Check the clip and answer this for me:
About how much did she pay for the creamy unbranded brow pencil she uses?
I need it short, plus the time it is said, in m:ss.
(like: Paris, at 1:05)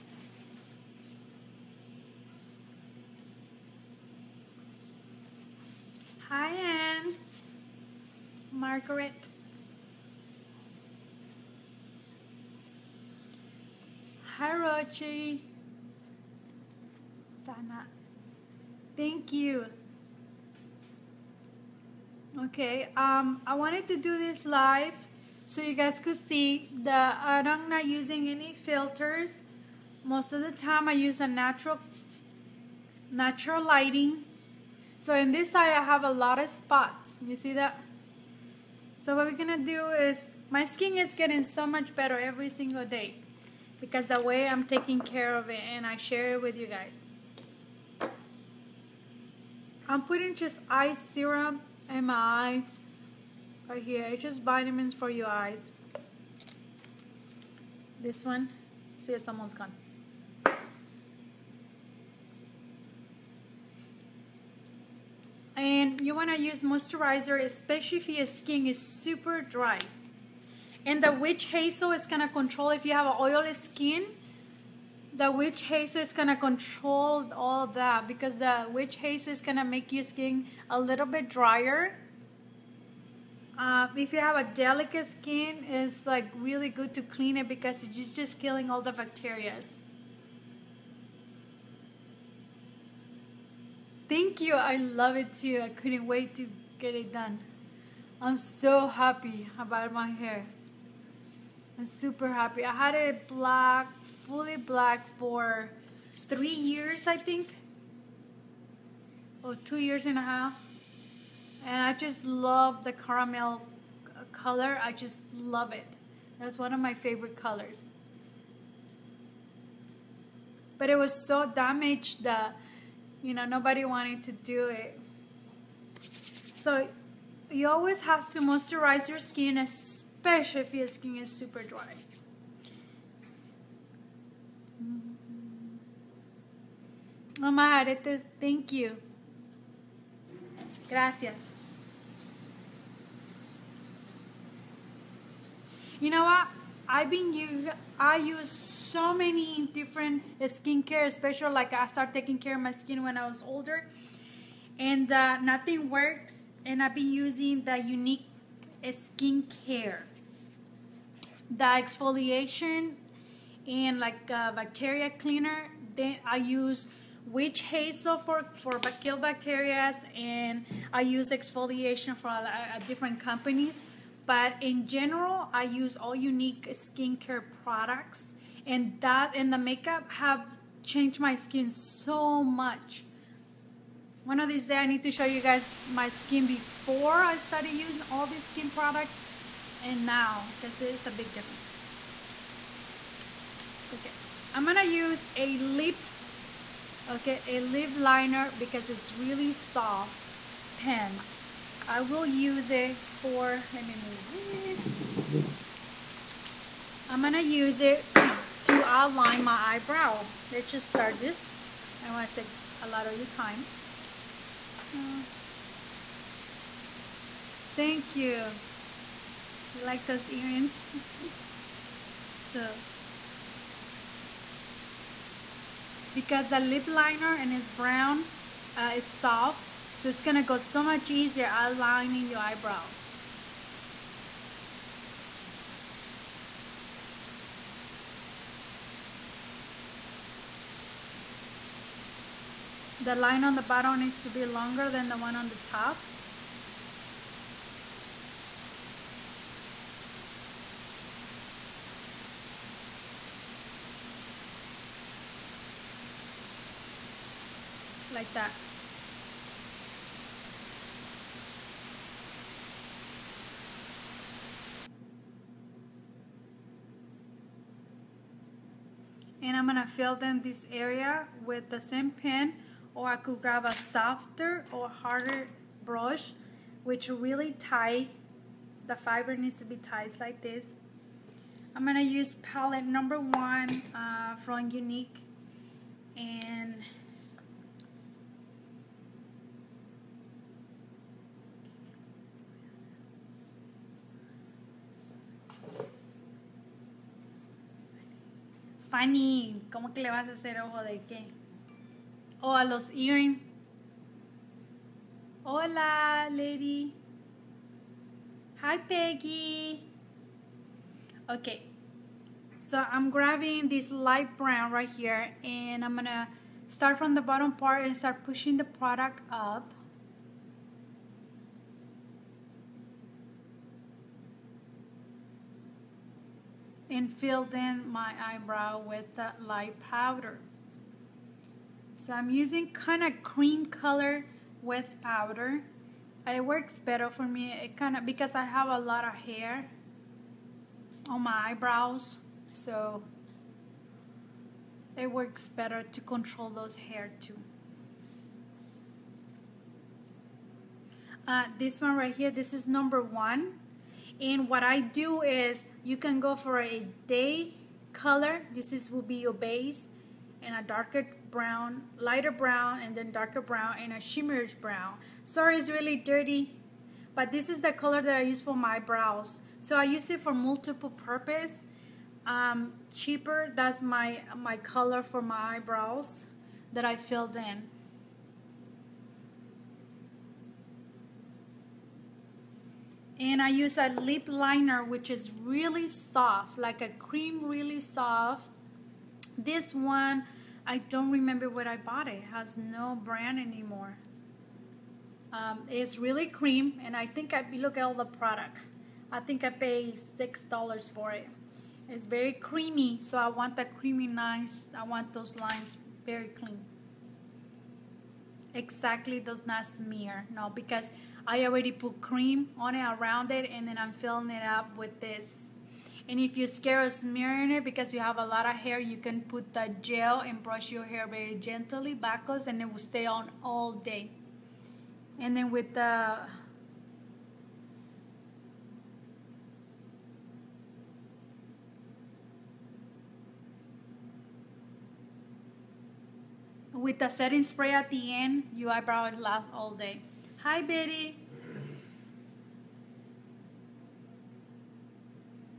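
$6, at 6:40.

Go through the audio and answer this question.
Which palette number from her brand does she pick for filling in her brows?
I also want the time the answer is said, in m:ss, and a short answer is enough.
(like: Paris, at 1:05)
1, at 4:42.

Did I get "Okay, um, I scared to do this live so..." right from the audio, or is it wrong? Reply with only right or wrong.
wrong.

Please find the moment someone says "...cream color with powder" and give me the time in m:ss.
5:33.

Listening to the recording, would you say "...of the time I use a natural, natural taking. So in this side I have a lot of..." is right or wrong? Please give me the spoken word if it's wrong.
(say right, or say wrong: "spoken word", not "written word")
wrong: "lighting", not "taking".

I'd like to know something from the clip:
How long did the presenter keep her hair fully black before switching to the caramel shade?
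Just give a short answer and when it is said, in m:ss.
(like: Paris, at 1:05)
2 and a half years, at 1:49.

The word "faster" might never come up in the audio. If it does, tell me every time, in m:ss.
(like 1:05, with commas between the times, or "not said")
not said.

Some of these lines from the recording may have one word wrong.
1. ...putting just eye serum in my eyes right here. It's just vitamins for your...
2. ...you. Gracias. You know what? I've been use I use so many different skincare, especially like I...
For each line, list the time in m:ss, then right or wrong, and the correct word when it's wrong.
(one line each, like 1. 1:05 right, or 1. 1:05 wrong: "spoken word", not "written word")
1. 0:50 right
2. 2:18 right.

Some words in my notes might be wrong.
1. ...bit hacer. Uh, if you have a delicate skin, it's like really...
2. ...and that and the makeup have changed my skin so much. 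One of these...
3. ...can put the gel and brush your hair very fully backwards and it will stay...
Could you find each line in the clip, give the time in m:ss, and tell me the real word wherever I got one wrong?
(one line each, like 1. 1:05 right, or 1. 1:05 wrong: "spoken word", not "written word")
1. 1:21 wrong: "drier", not "hacer"
2. 2:58 right
3. 6:58 wrong: "gently", not "fully".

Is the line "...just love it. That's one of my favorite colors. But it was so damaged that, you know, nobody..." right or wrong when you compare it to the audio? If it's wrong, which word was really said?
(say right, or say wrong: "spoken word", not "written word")
right.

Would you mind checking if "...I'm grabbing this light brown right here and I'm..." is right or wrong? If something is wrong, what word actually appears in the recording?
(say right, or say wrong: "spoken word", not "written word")
right.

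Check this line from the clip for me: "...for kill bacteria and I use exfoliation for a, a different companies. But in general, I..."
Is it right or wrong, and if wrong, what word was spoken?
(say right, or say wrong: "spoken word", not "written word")
right.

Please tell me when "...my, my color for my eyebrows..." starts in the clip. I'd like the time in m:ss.
6:13.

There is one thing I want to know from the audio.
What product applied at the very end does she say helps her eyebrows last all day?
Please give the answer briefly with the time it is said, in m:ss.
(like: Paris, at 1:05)
setting spray, at 7:17.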